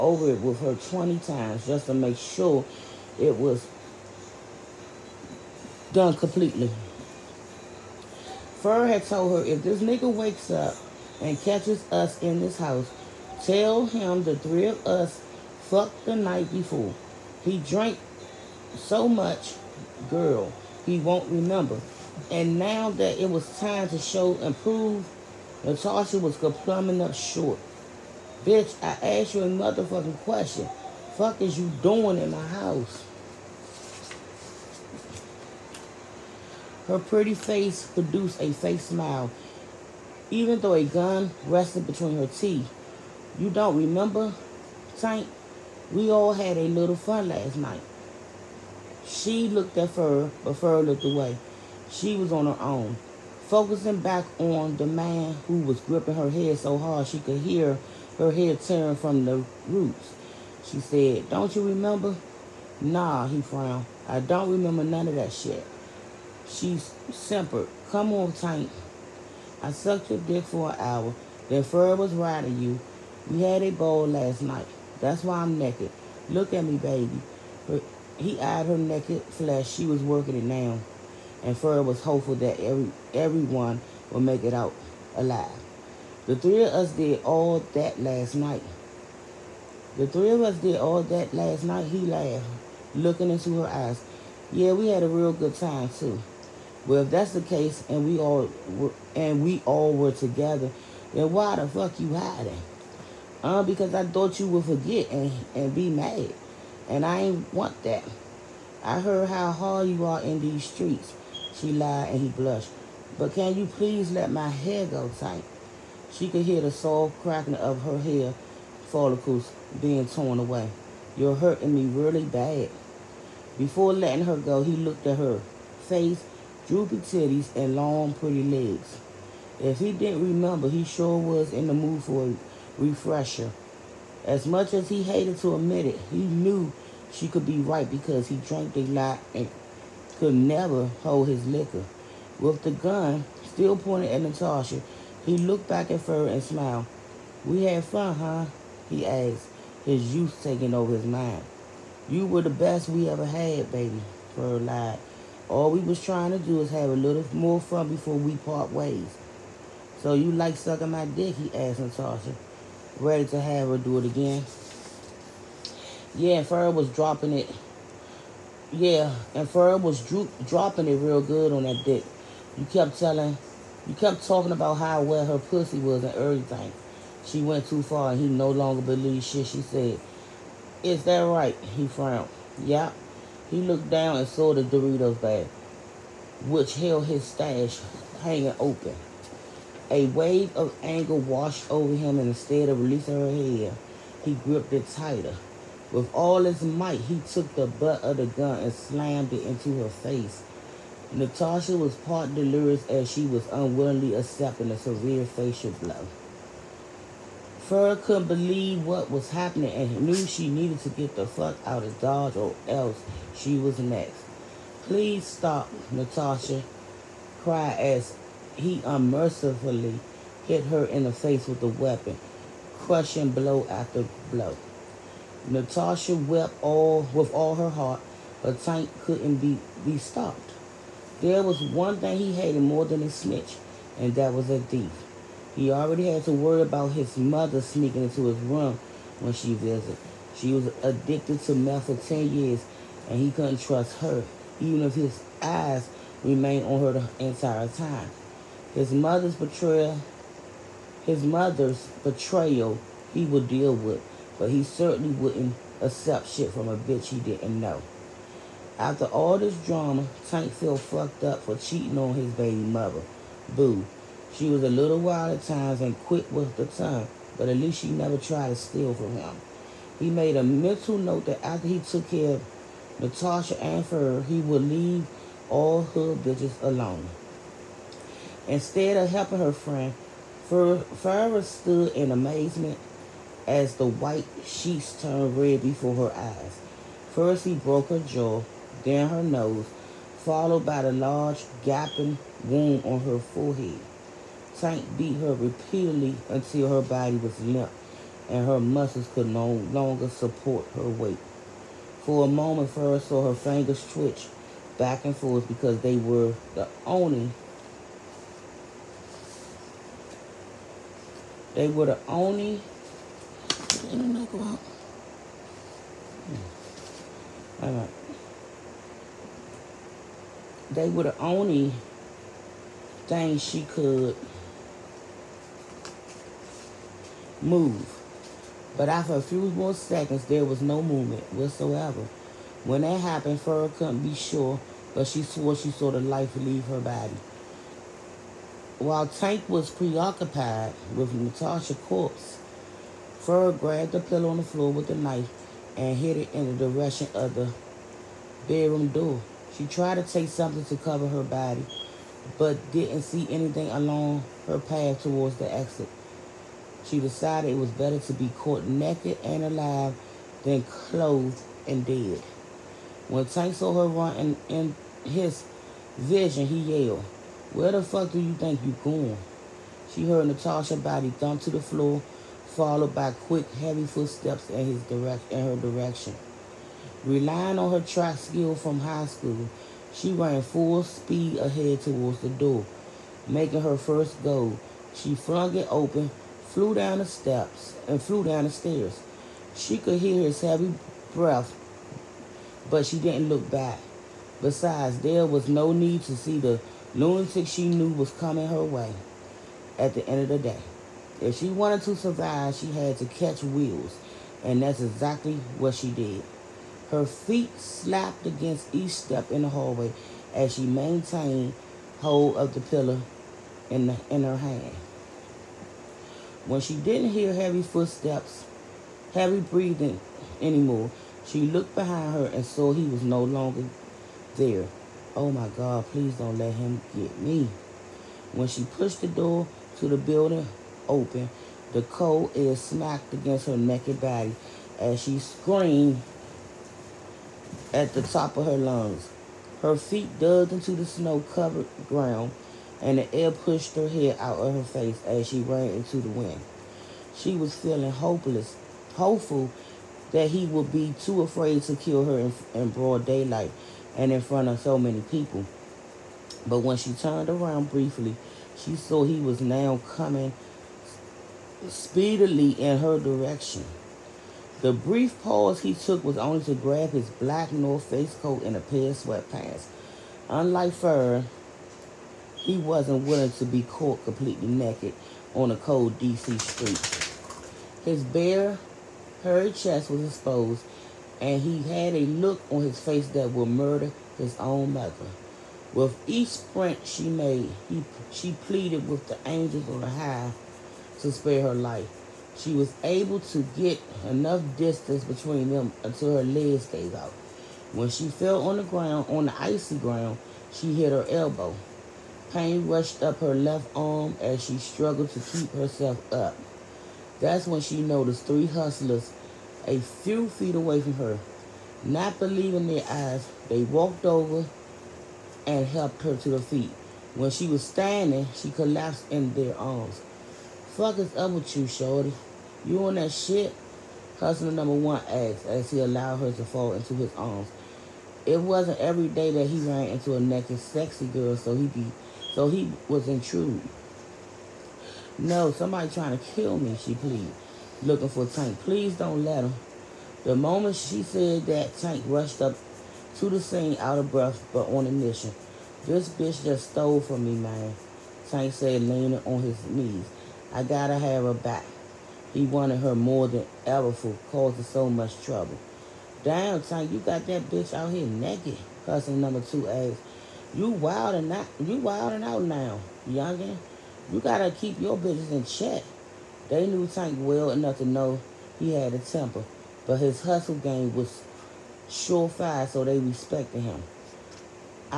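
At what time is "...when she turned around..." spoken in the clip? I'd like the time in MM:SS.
07:36.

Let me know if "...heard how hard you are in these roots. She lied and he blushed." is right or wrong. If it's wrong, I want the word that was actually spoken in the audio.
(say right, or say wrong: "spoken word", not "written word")
wrong: "streets", not "roots".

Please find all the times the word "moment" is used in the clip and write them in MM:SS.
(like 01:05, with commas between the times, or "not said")
05:02, 09:00.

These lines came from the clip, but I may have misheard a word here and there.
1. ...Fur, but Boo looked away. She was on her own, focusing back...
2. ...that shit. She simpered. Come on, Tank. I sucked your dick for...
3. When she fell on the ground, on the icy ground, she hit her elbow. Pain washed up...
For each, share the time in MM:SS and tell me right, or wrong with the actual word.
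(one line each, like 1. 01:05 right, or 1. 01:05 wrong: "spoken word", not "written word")
1. 00:49 wrong: "Fur", not "Boo"
2. 01:05 right
3. 08:17 wrong: "rushed", not "washed".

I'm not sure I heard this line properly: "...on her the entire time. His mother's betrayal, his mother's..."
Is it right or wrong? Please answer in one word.
right.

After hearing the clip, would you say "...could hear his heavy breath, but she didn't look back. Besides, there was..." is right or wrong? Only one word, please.
right.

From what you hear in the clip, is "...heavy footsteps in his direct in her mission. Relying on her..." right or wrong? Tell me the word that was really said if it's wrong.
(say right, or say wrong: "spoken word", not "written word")
wrong: "direction", not "mission".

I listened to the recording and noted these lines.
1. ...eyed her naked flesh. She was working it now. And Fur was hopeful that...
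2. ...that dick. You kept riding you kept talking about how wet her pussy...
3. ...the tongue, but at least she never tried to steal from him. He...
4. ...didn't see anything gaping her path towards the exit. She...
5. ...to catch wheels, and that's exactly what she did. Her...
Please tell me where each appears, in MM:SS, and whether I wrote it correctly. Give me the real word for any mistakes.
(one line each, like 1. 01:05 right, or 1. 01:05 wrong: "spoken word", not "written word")
1. 01:18 right
2. 02:51 wrong: "telling", not "riding"
3. 04:26 right
4. 05:52 wrong: "along", not "gaping"
5. 06:42 right.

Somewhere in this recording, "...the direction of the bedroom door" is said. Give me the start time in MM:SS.
05:46.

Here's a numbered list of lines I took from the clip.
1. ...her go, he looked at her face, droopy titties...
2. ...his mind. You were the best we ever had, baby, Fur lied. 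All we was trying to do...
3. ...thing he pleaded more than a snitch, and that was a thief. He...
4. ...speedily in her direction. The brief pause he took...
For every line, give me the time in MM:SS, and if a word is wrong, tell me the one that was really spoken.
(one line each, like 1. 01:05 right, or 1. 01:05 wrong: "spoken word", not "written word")
1. 02:04 right
2. 02:30 right
3. 03:51 wrong: "hated", not "pleaded"
4. 07:41 right.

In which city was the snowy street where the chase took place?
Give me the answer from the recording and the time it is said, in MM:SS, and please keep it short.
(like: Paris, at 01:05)
D.C., at 07:55.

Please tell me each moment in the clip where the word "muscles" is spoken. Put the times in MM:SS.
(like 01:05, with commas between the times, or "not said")
04:58.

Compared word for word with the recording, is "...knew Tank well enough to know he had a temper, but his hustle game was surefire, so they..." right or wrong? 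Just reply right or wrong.
right.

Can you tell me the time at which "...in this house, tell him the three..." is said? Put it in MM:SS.
00:12.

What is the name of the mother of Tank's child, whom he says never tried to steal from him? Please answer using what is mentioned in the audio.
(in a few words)
Boo.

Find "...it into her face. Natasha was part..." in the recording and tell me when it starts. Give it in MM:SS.
03:19.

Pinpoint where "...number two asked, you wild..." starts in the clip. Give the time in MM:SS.
09:19.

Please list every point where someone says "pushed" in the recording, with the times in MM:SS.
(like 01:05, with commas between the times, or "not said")
07:08, 07:23.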